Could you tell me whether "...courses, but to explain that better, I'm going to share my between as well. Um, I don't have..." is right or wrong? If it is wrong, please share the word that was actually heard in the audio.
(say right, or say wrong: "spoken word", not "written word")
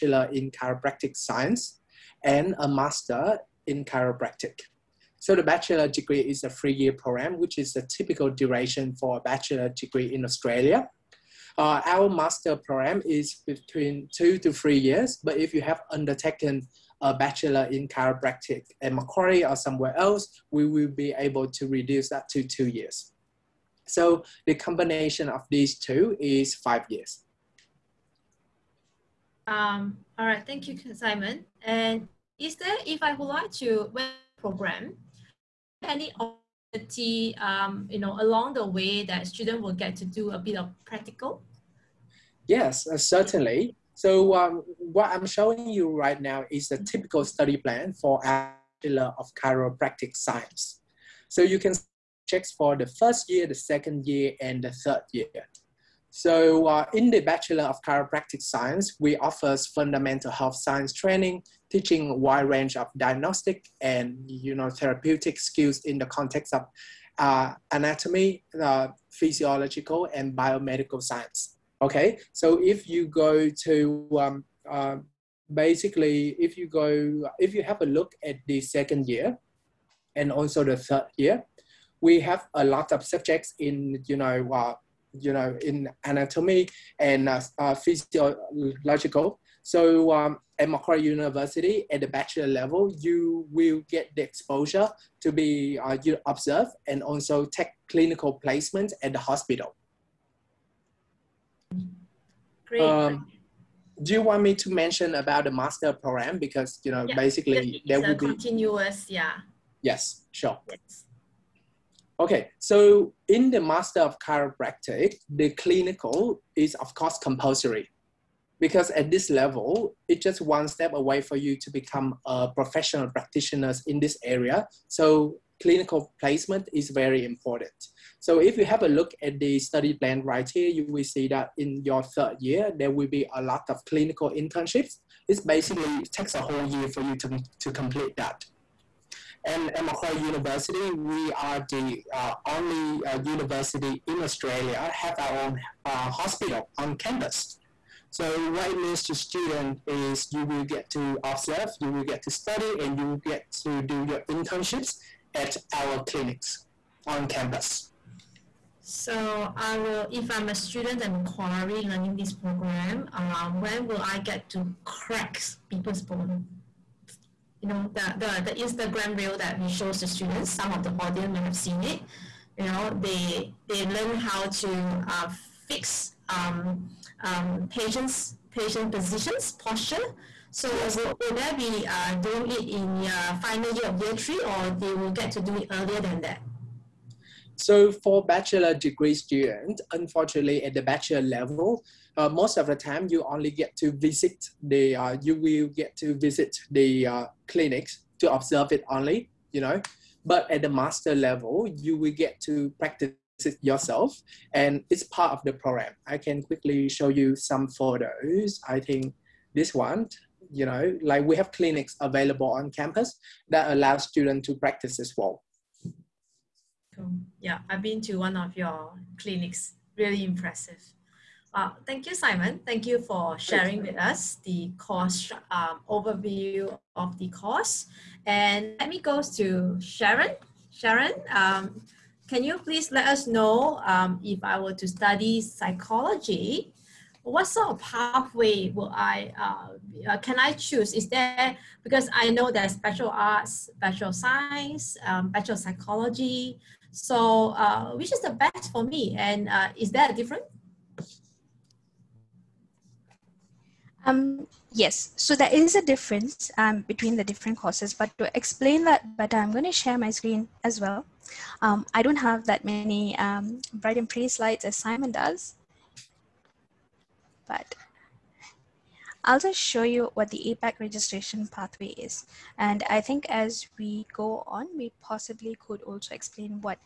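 wrong: "screen", not "between".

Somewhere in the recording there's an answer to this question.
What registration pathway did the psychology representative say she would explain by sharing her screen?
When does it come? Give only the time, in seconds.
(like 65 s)
270 s.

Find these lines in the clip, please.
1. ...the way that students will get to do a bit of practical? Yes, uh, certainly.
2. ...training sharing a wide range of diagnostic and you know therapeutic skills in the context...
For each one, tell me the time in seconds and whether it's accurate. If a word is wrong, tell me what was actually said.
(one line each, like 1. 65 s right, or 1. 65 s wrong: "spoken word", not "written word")
1. 38 s right
2. 60 s wrong: "teaching", not "sharing".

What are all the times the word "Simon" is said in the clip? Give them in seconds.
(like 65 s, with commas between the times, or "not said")
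30 s, 222 s, 264 s.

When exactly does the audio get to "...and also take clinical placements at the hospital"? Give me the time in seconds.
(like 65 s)
96 s.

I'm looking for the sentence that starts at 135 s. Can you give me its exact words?
It basically takes a whole year for you to, to complete that.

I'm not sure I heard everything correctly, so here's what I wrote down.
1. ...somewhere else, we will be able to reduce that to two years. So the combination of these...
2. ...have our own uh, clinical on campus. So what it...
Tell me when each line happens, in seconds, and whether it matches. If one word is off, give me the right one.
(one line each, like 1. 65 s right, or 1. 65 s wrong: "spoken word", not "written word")
1. 19 s right
2. 144 s wrong: "hospital", not "clinical".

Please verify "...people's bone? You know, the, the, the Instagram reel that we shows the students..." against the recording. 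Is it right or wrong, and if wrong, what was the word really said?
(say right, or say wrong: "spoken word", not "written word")
right.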